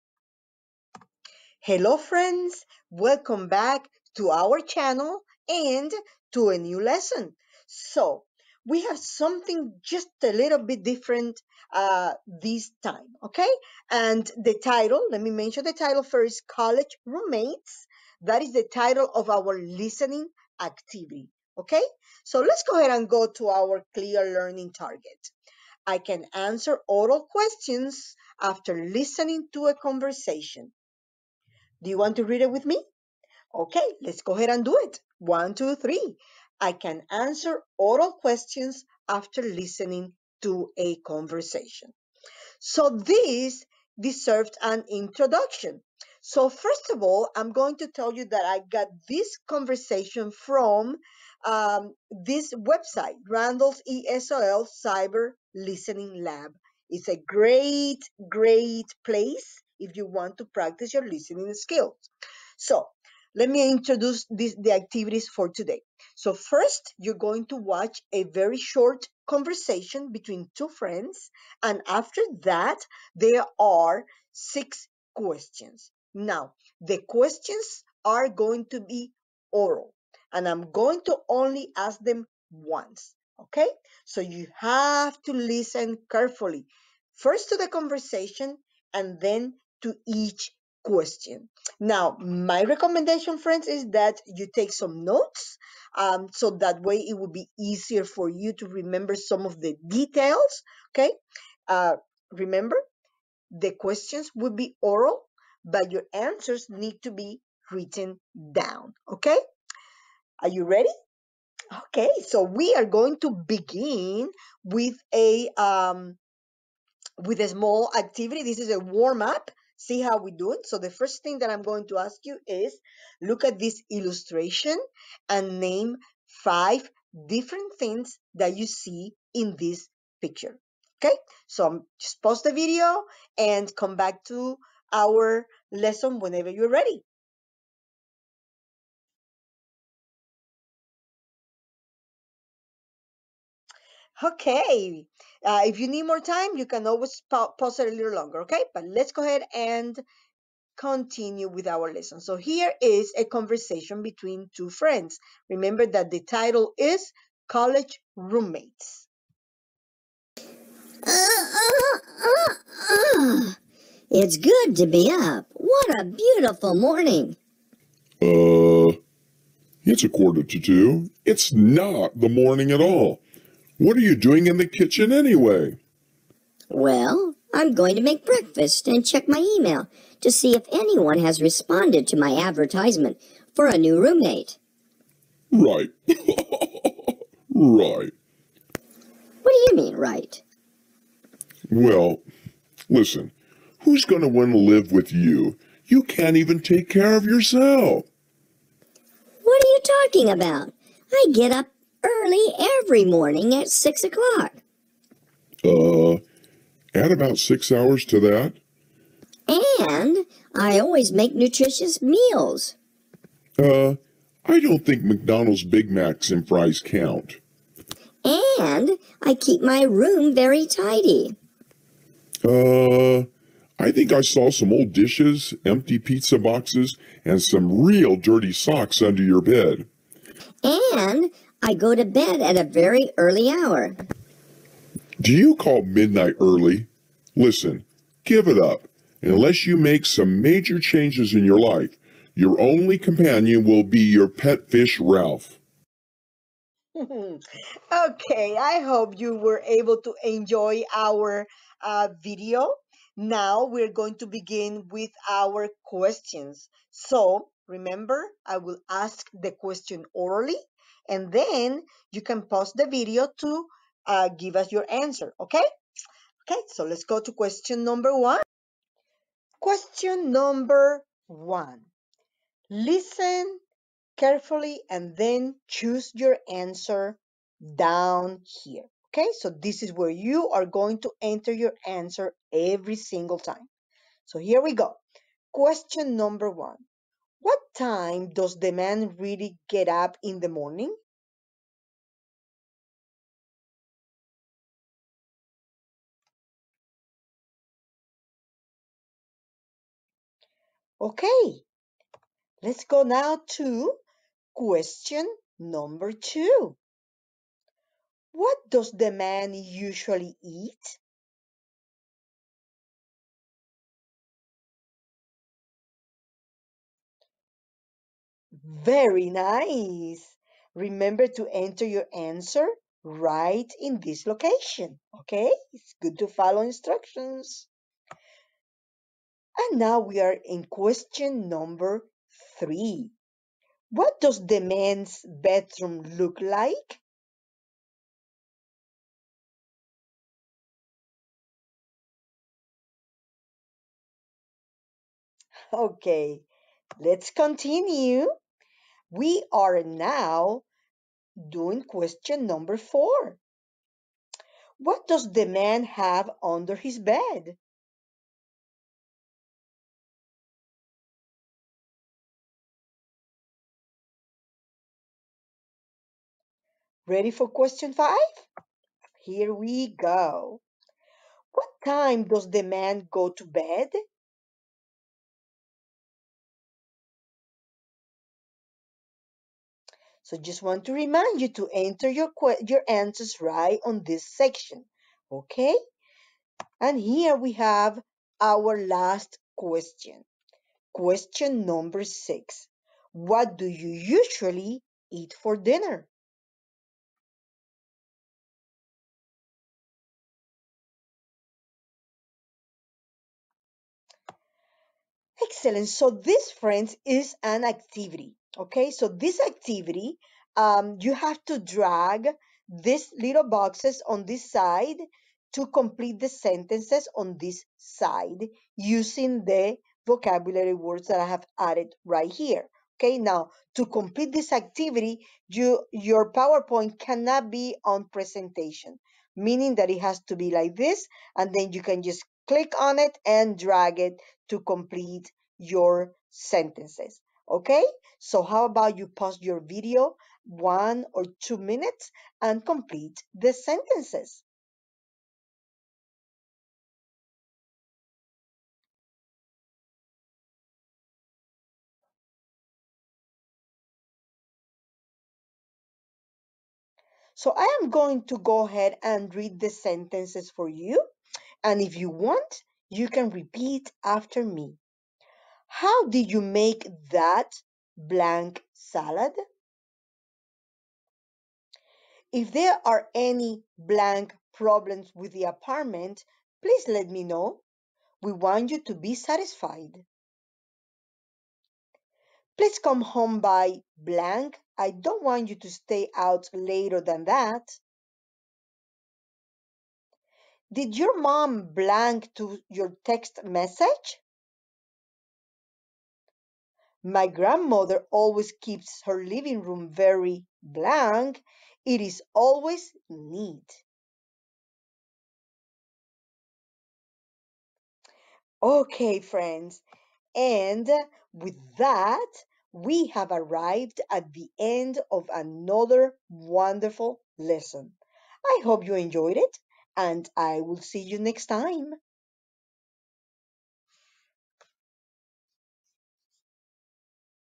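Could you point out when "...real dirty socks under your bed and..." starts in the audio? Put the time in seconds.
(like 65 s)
227 s.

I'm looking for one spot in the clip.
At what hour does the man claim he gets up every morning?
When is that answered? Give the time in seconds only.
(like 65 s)
203 s.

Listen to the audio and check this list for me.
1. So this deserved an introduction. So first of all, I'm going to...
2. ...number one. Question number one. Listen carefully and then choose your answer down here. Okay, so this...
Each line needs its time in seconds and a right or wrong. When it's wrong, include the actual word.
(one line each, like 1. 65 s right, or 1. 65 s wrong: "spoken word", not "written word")
1. 42 s right
2. 267 s right.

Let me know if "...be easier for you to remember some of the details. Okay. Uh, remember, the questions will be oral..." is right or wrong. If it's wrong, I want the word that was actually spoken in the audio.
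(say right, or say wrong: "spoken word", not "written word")
right.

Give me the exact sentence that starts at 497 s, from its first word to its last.
My grandmother always keeps her living room very blank.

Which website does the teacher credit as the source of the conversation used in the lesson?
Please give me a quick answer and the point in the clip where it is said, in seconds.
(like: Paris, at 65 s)
Randall's ESOL Cyber Listening Lab, at 53 s.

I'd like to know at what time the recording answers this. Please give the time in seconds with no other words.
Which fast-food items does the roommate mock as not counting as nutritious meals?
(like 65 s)
215 s.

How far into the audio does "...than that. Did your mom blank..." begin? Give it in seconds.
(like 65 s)
486 s.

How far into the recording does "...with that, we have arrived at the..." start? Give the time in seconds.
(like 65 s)
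511 s.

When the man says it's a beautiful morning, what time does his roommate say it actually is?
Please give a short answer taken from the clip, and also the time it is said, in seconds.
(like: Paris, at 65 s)
A quarter to two, at 170 s.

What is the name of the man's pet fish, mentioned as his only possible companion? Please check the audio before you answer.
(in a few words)
Ralph.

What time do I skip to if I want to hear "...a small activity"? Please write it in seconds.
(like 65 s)
117 s.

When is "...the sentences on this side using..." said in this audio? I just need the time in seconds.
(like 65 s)
416 s.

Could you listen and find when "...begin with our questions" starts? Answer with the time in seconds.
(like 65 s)
254 s.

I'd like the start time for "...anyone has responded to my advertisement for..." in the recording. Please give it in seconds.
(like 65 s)
180 s.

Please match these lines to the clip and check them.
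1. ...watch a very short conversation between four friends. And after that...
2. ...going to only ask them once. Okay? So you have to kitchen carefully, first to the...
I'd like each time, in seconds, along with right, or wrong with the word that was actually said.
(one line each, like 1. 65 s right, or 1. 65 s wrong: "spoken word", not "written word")
1. 67 s wrong: "two", not "four"
2. 80 s wrong: "listen", not "kitchen".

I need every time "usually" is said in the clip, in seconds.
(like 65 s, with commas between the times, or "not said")
309 s, 393 s.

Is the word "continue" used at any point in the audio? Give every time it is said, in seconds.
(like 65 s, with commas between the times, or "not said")
150 s, 347 s.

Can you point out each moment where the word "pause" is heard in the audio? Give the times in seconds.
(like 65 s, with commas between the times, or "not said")
132 s, 147 s, 262 s, 439 s.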